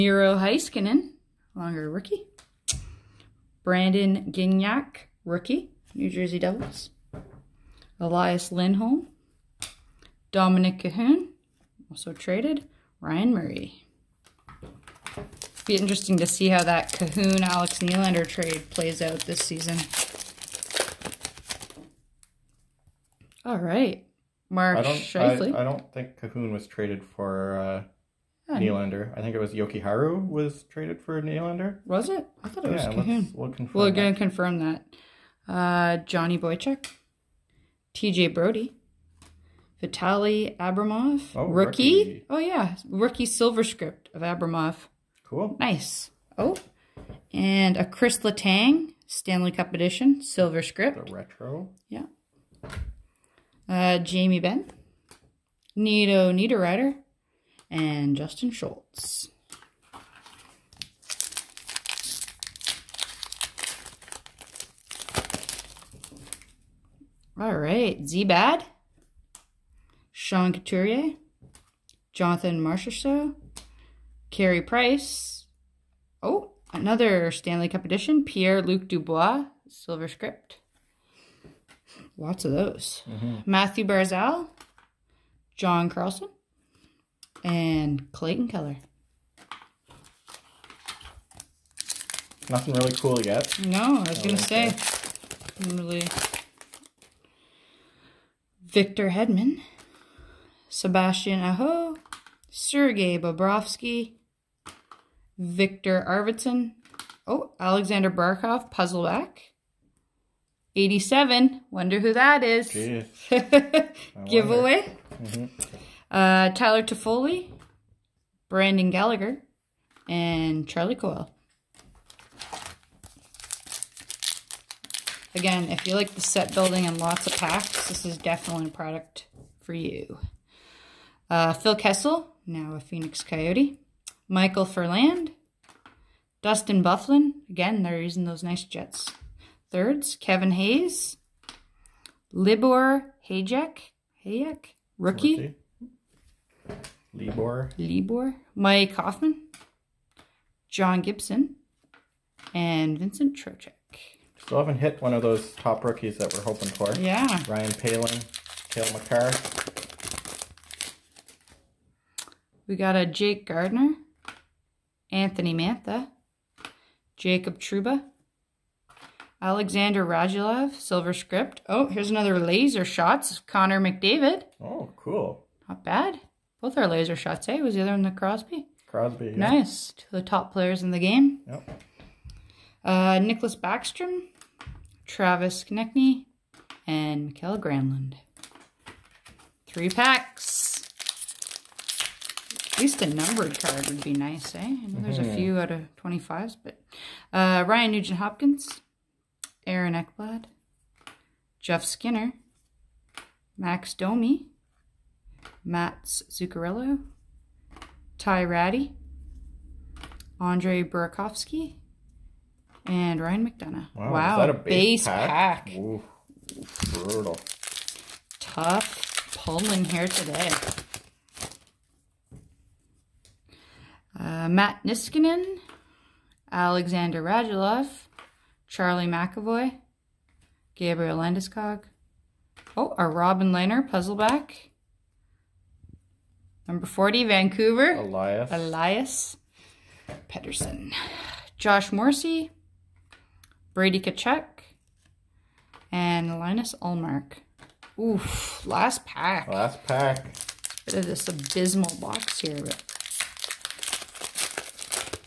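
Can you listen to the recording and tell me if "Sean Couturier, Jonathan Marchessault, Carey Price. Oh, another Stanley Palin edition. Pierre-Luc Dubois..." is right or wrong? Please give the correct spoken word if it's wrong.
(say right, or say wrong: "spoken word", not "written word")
wrong: "Cup", not "Palin".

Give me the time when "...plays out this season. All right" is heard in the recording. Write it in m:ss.
0:18.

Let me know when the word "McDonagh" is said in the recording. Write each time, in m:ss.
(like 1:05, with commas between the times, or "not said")
3:33.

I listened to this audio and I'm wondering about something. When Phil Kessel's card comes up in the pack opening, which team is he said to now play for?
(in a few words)
Phoenix Coyote.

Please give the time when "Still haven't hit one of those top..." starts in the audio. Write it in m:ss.
2:34.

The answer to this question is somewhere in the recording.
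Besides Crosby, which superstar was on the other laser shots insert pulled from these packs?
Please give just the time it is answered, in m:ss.
2:53.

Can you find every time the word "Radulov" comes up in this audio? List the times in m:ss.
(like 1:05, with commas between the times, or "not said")
2:50, 3:47.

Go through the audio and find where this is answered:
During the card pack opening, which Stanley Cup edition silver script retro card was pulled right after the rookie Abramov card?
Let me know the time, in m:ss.
0:47.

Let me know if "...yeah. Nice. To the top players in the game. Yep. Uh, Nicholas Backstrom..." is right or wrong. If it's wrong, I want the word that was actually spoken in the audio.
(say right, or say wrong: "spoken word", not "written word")
right.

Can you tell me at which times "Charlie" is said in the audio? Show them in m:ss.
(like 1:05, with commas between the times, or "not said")
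2:00, 3:48.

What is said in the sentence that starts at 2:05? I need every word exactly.
Again, if you like the set building and lots of packs, this is definitely a product for you.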